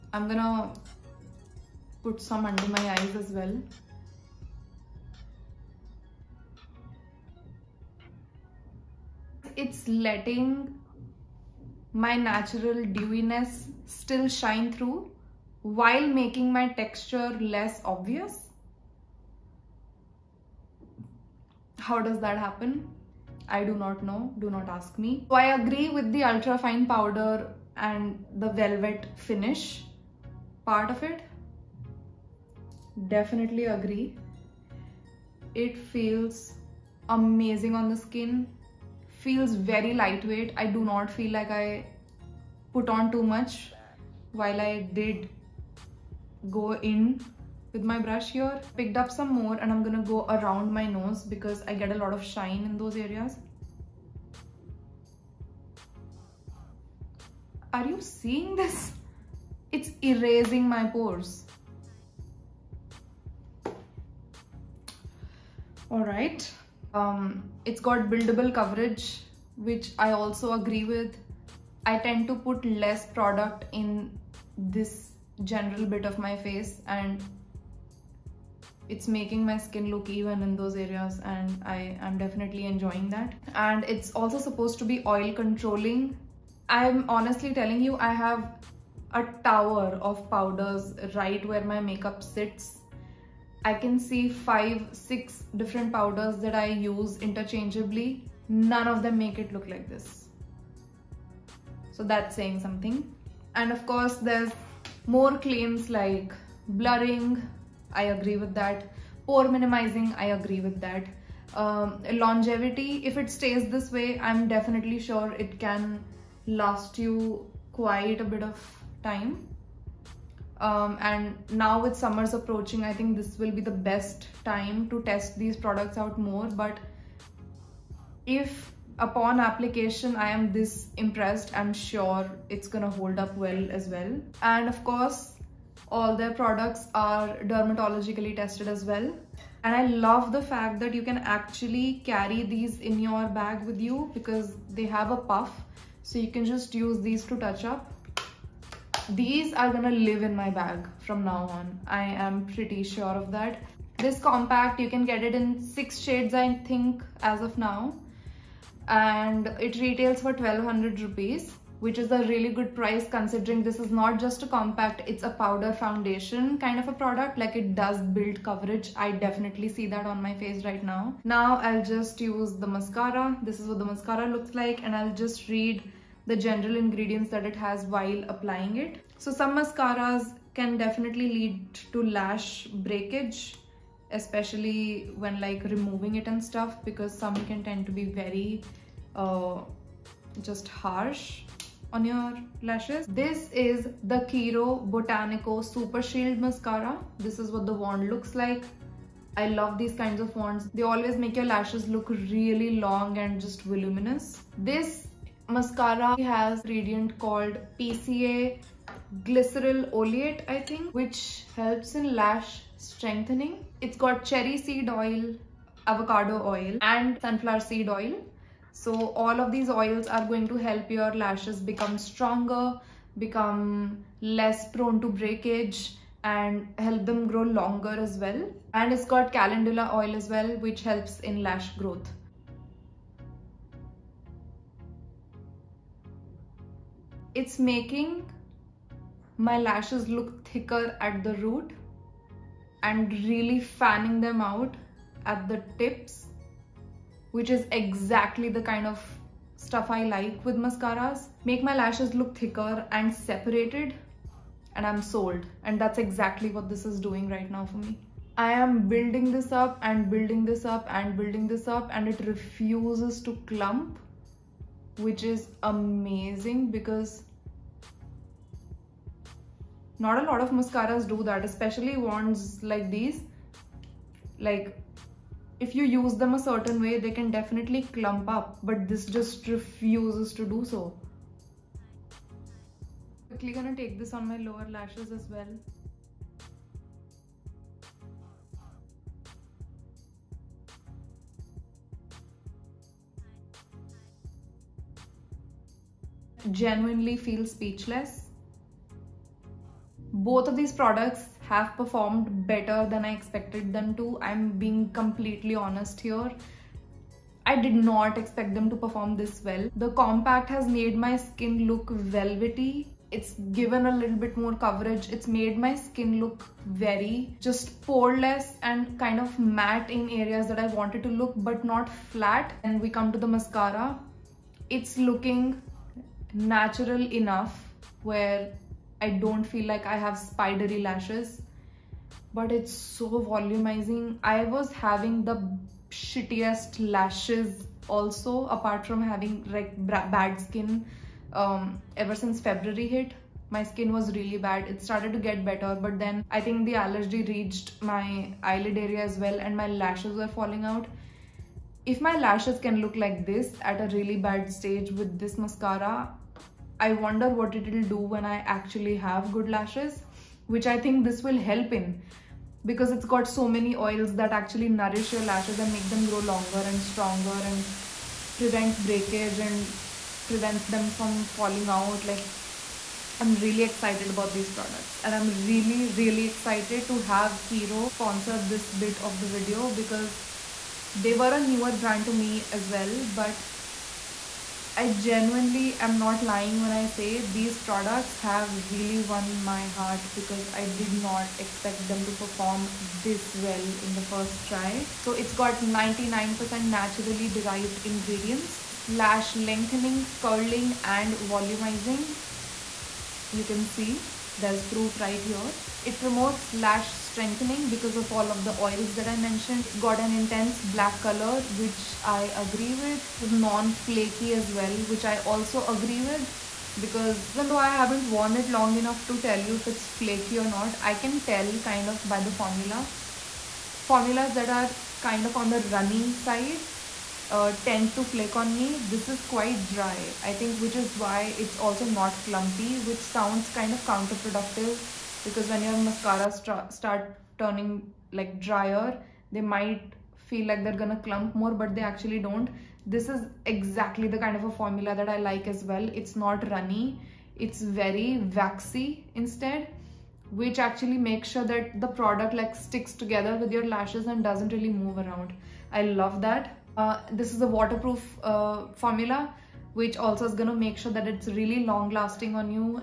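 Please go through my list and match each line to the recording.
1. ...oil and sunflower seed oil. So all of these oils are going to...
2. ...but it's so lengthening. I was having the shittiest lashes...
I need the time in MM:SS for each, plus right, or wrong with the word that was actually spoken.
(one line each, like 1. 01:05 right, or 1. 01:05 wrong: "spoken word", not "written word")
1. 03:36 right
2. 05:32 wrong: "volumizing", not "lengthening".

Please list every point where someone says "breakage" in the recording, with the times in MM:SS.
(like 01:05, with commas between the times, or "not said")
03:02, 03:45, 06:08.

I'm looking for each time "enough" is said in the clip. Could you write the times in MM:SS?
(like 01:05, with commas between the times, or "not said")
05:27, 06:58.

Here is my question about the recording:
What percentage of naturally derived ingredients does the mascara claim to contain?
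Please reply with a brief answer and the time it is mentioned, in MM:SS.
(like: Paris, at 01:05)
99%, at 06:35.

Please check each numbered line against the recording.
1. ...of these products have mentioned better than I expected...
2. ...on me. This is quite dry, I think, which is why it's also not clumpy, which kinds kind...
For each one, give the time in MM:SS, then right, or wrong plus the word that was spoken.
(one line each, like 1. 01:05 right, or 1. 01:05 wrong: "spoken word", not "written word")
1. 05:00 wrong: "performed", not "mentioned"
2. 07:08 wrong: "sounds", not "kinds".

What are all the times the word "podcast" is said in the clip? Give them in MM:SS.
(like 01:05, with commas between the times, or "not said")
not said.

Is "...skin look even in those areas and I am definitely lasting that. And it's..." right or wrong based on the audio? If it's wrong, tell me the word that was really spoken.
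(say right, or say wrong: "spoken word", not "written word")
wrong: "enjoying", not "lasting".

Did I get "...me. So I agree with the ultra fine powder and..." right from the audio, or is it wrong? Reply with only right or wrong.
right.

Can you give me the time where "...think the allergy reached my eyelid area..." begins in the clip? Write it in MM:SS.
05:46.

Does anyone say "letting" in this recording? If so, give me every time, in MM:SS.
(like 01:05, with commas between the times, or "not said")
00:09.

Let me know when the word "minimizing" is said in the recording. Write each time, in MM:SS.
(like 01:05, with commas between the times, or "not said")
01:49.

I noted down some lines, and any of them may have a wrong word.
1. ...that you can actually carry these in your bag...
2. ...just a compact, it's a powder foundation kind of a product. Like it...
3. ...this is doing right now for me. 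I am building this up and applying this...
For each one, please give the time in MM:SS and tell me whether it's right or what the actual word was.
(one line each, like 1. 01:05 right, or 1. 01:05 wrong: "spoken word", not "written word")
1. 02:20 right
2. 02:44 right
3. 04:16 wrong: "building", not "applying".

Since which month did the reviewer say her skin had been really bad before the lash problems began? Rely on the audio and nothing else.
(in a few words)
February.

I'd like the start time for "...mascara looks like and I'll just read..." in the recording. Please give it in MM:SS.
02:53.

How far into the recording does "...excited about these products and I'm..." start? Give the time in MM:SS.
06:13.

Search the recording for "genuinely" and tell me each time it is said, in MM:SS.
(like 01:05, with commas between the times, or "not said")
04:56, 06:24.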